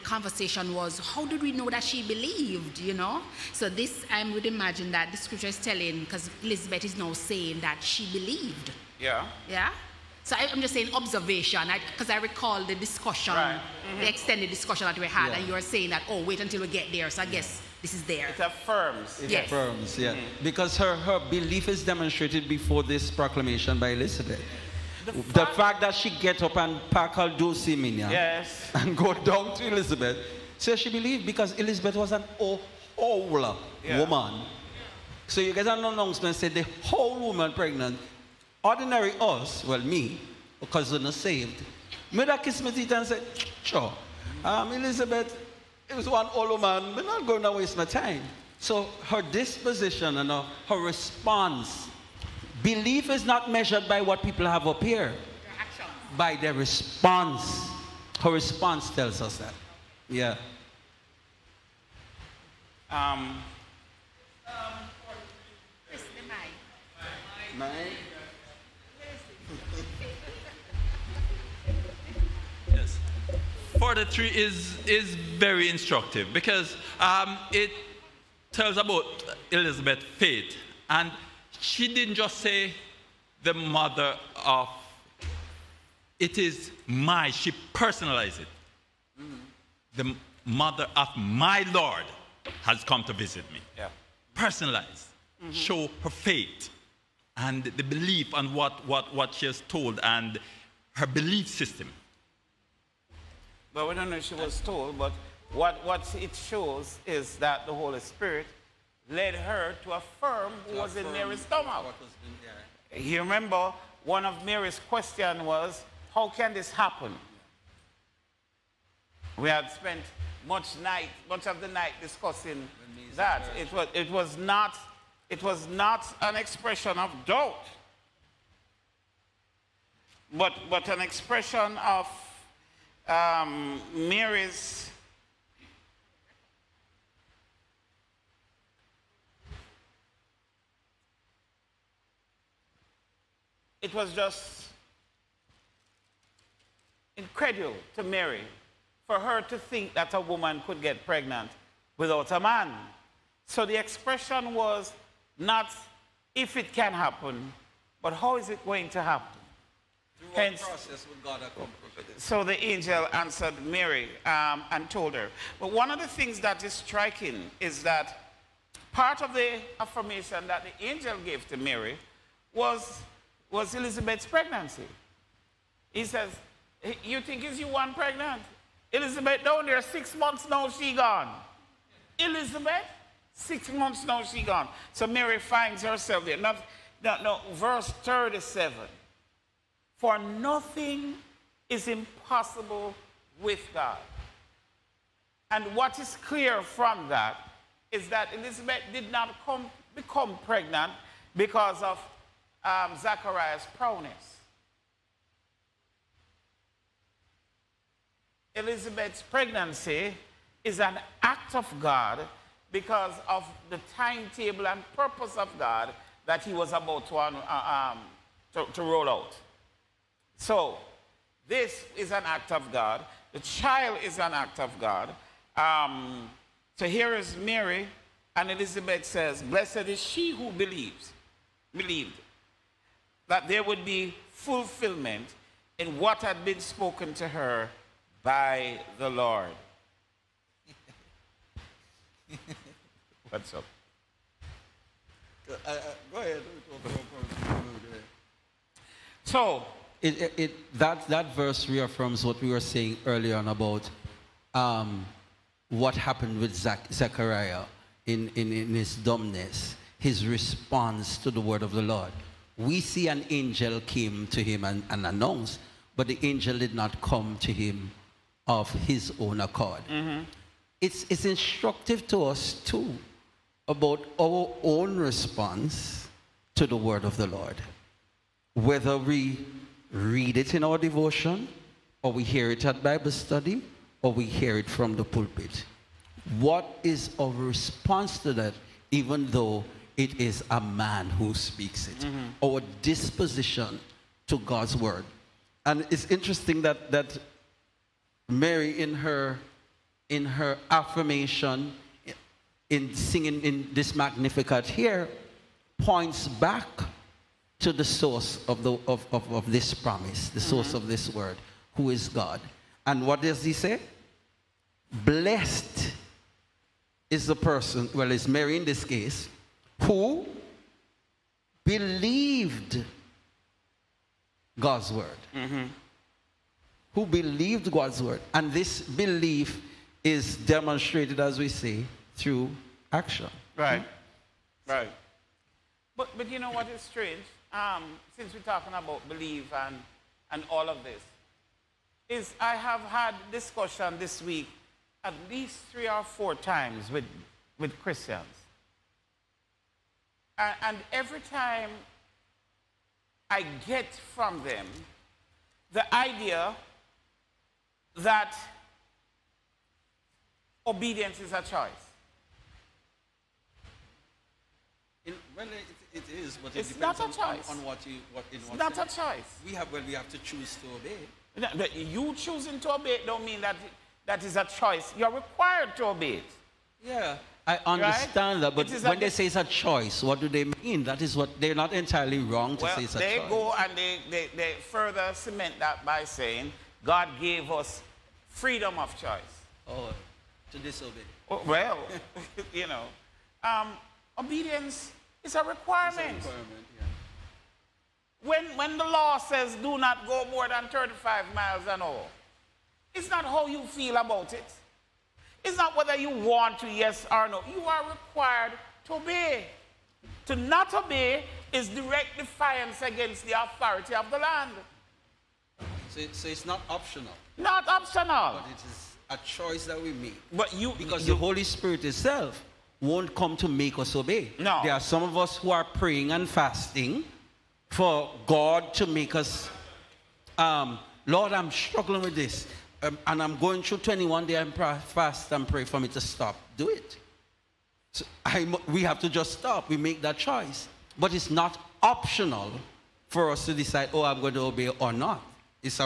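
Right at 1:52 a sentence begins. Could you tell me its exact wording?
You remember, one of Mary's questions was, how can this happen?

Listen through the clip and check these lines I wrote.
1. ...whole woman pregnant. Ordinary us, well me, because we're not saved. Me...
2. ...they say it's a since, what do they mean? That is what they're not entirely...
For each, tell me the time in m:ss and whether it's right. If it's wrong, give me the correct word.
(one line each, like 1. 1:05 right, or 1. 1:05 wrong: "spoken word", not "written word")
1. 0:36 right
2. 6:18 wrong: "choice", not "since".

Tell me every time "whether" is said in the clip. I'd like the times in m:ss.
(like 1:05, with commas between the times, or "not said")
4:38, 6:45.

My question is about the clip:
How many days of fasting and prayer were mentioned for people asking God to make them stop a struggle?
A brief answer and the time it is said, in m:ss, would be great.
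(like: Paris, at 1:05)
21, at 7:13.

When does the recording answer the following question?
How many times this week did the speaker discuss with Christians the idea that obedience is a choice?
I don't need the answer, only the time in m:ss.
5:45.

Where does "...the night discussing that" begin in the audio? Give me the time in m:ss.
2:01.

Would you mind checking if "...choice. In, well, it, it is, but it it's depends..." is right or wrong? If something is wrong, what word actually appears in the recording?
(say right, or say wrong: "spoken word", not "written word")
right.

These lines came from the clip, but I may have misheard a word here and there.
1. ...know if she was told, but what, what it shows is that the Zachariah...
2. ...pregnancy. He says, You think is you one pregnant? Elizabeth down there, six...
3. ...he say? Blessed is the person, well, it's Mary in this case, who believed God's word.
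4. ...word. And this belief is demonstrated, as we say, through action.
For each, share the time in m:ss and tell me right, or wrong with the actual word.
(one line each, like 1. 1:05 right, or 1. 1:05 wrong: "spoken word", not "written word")
1. 1:44 wrong: "Holy", not "Zachariah"
2. 2:54 right
3. 5:13 right
4. 5:28 right.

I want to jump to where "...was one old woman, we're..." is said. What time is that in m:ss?
0:45.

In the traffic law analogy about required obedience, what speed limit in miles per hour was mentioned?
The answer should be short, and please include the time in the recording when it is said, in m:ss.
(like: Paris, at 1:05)
35, at 6:40.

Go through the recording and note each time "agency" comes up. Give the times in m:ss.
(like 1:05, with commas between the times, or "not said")
not said.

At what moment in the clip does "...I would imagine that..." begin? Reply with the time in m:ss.
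0:04.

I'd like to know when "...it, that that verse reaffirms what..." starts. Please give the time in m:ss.
4:10.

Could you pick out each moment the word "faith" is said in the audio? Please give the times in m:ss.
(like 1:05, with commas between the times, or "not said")
1:20, 1:36.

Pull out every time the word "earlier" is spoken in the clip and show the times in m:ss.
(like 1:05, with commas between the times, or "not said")
4:13.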